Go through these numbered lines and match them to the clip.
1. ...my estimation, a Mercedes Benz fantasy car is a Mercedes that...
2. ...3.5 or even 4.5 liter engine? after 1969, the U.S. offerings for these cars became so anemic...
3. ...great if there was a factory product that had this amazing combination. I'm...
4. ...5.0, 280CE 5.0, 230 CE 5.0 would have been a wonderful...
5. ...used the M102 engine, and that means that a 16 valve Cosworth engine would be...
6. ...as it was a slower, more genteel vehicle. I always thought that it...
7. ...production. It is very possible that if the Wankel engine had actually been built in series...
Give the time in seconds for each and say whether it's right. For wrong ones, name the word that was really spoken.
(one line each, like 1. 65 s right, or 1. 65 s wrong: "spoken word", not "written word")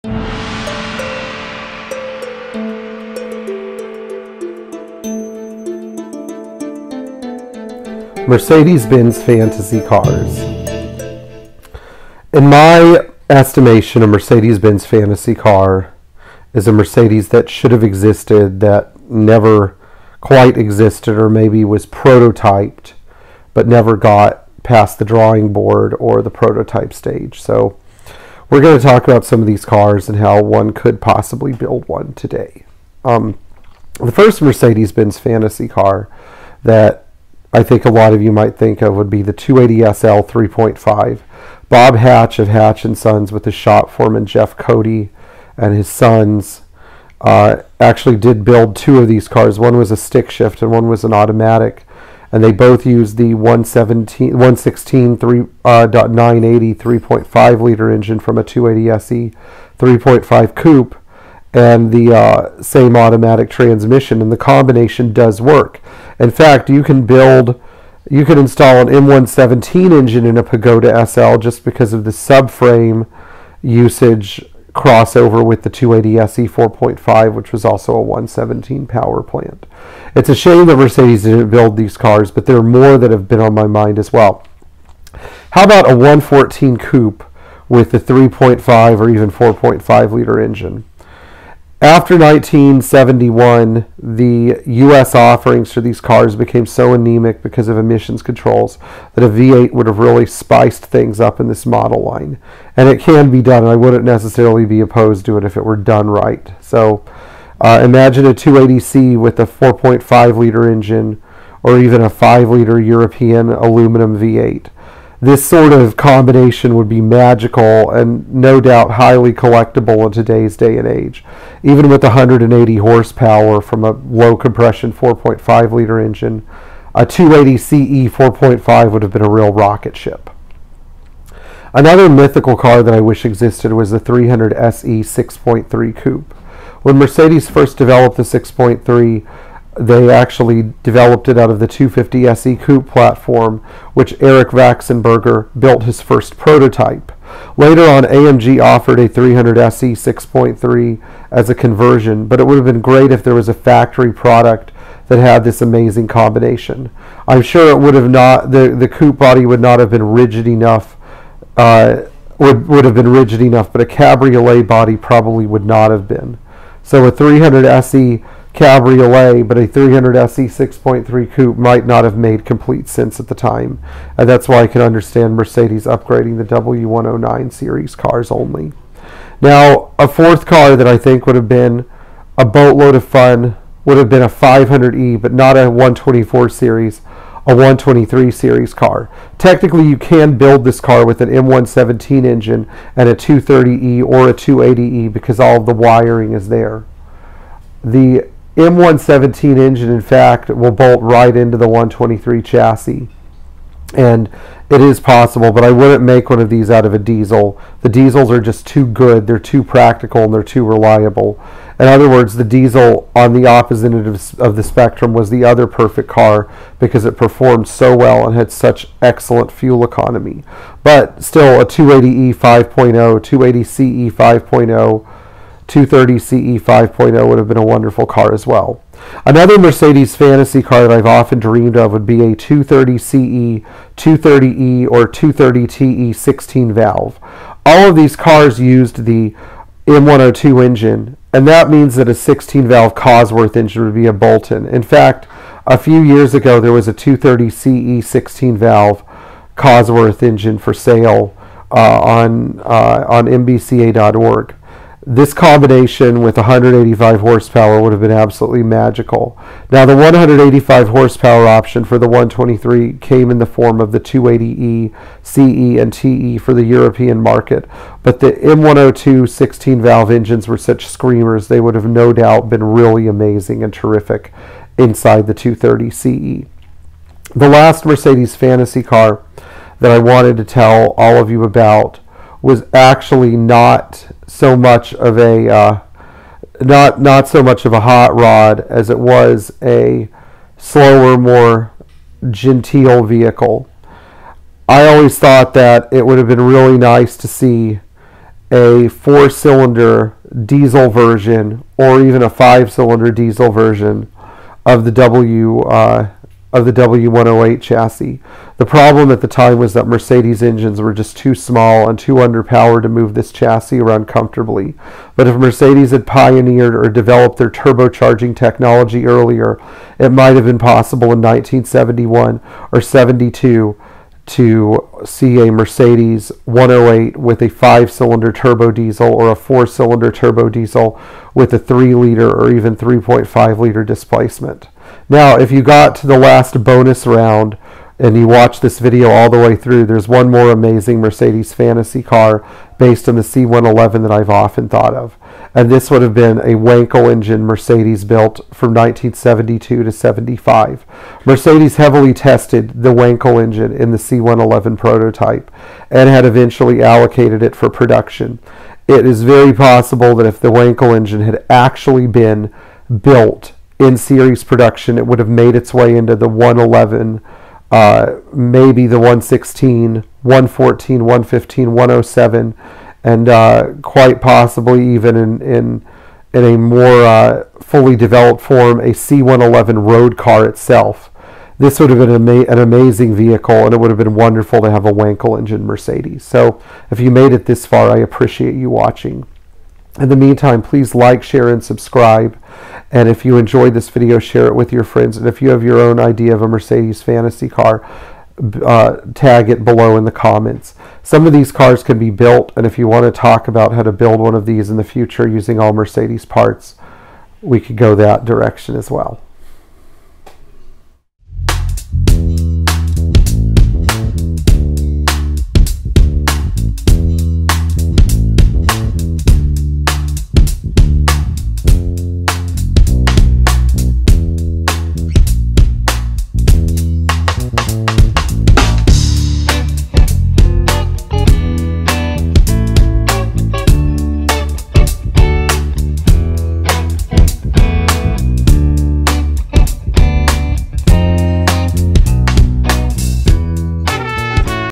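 1. 12 s right
2. 87 s wrong: "1971", not "1969"
3. 152 s right
4. 222 s right
5. 238 s right
6. 288 s right
7. 357 s right.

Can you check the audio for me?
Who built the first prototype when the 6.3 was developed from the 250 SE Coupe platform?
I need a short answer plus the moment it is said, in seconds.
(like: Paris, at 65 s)
Eric Waxenberger, at 144 s.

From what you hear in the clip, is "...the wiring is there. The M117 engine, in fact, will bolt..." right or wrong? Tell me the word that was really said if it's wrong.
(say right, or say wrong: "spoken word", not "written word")
right.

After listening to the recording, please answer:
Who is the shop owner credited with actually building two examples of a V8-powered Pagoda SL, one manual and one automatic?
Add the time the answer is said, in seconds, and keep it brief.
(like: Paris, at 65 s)
Bob Hatch, at 41 s.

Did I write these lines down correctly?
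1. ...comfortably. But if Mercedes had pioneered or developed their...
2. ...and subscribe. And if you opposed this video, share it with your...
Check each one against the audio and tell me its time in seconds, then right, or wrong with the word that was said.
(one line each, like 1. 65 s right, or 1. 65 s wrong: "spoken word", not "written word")
1. 314 s right
2. 391 s wrong: "enjoyed", not "opposed".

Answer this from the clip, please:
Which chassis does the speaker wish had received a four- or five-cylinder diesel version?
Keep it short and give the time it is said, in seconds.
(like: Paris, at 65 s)
W108, at 306 s.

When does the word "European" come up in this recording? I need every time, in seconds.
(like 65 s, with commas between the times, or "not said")
112 s, 266 s.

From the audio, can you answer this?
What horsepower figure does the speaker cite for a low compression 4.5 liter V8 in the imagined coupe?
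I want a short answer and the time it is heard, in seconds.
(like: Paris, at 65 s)
180, at 122 s.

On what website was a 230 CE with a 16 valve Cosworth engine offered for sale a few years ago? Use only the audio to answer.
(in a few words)
MBCA.org.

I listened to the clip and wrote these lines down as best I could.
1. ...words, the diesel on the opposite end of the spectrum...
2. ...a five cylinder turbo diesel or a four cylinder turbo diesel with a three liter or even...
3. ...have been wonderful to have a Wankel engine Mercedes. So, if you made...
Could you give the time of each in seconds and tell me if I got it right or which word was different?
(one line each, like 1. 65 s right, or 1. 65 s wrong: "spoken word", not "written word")
1. 212 s right
2. 327 s right
3. 383 s right.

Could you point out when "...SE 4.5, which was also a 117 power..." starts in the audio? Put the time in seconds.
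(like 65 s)
76 s.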